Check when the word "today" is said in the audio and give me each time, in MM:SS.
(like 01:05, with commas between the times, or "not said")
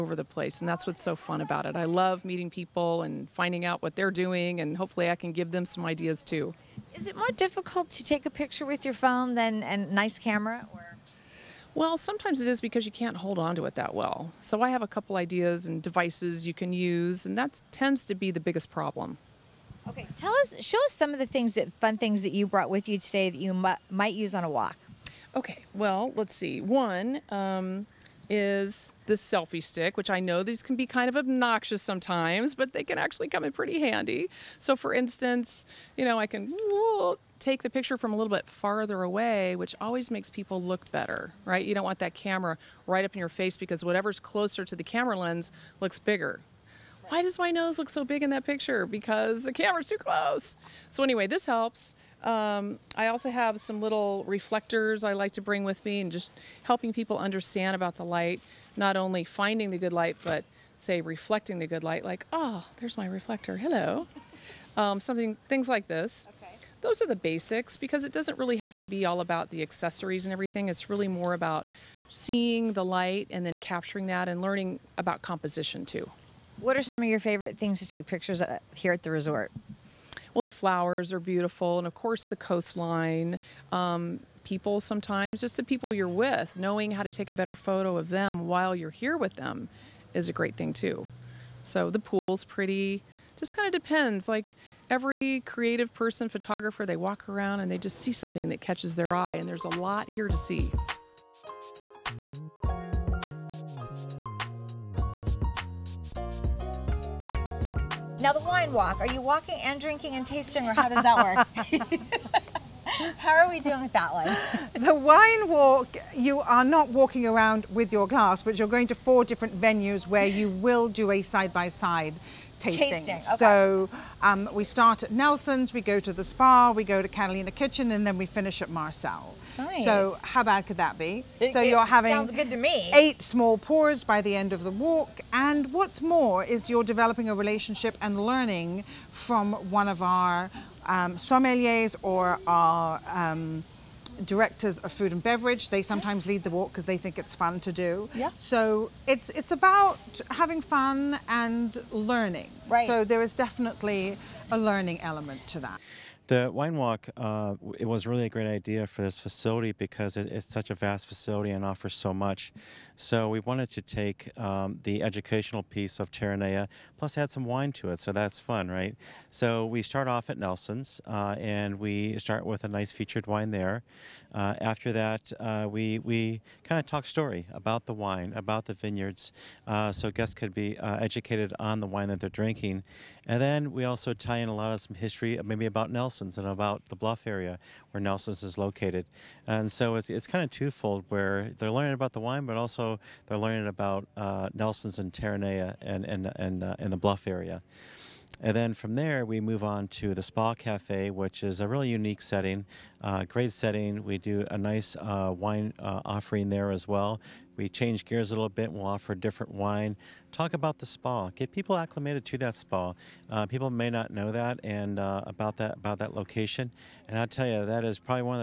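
00:22.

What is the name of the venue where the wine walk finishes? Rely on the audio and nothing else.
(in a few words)
Marcel.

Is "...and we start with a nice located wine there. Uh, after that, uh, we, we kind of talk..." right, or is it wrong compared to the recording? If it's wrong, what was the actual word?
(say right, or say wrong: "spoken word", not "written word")
wrong: "featured", not "located".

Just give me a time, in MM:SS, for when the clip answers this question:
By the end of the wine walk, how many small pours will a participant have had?
02:12.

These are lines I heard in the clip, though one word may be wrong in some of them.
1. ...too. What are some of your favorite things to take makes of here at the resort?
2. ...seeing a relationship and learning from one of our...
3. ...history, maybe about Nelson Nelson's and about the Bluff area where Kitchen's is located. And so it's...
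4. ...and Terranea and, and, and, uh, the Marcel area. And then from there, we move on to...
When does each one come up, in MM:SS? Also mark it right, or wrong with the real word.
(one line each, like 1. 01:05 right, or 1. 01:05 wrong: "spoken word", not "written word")
1. 01:15 wrong: "pictures", not "makes"
2. 02:16 wrong: "developing", not "seeing"
3. 03:04 wrong: "Nelson", not "Kitchen"
4. 03:14 wrong: "Bluff", not "Marcel".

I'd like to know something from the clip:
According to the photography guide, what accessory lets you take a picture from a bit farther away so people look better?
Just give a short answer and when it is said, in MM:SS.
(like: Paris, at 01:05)
selfie stick, at 00:29.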